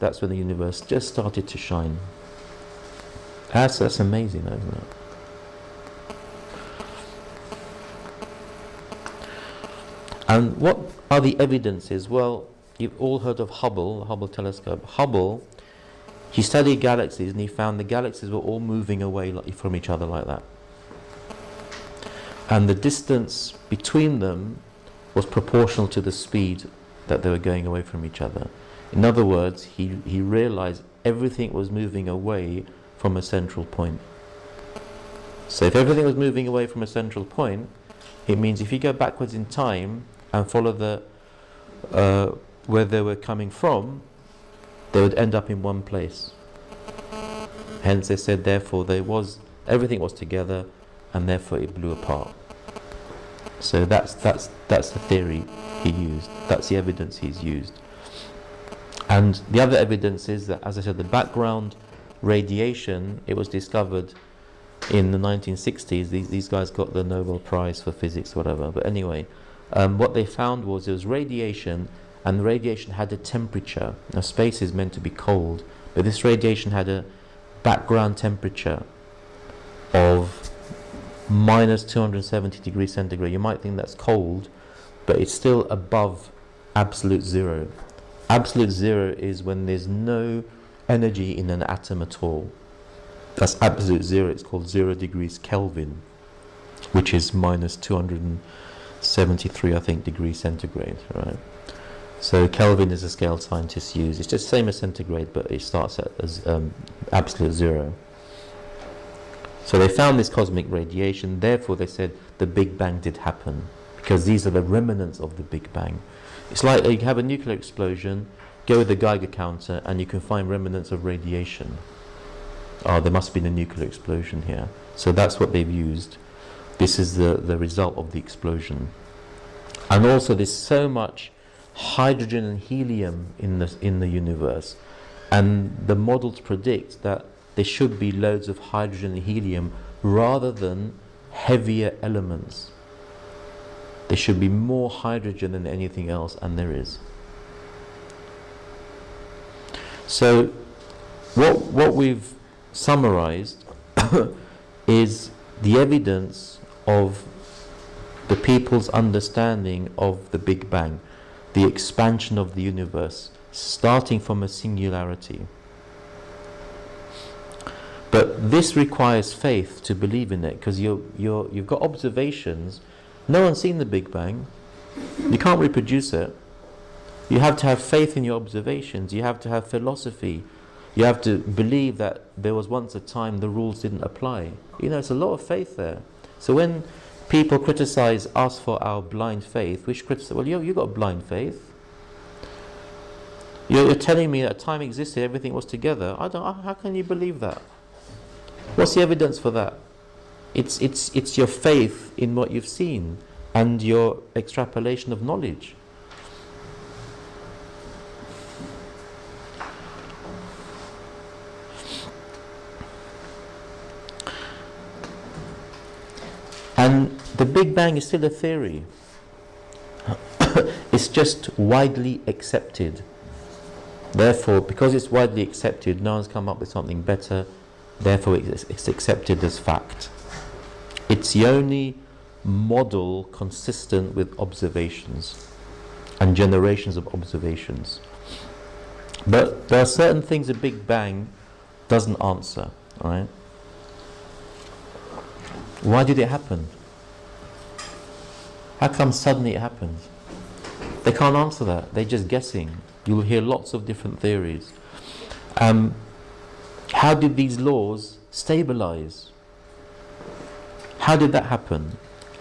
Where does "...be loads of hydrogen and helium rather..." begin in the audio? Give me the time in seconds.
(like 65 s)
137 s.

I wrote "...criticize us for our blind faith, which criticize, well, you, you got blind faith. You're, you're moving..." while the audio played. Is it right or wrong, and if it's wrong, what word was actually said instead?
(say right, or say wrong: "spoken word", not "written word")
wrong: "telling", not "moving".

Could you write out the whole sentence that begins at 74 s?
Now, space is meant to be cold, but this radiation had a background temperature of minus 270 degrees centigrade.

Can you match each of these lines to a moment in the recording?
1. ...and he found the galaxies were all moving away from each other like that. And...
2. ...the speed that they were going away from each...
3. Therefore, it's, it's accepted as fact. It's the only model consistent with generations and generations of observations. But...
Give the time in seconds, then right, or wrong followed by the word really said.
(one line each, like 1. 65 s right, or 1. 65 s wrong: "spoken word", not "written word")
1. 17 s right
2. 26 s right
3. 227 s wrong: "observations", not "generations".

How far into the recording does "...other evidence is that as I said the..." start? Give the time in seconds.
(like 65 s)
59 s.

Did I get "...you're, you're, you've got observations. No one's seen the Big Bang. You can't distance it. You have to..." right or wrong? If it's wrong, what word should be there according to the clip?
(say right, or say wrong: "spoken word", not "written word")
wrong: "reproduce", not "distance".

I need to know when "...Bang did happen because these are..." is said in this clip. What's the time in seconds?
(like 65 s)
112 s.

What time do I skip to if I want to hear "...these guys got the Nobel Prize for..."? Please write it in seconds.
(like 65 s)
66 s.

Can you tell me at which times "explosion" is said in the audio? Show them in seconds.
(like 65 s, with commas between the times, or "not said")
117 s, 123 s, 128 s.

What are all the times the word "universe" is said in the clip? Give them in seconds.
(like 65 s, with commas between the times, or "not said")
0 s, 134 s, 162 s.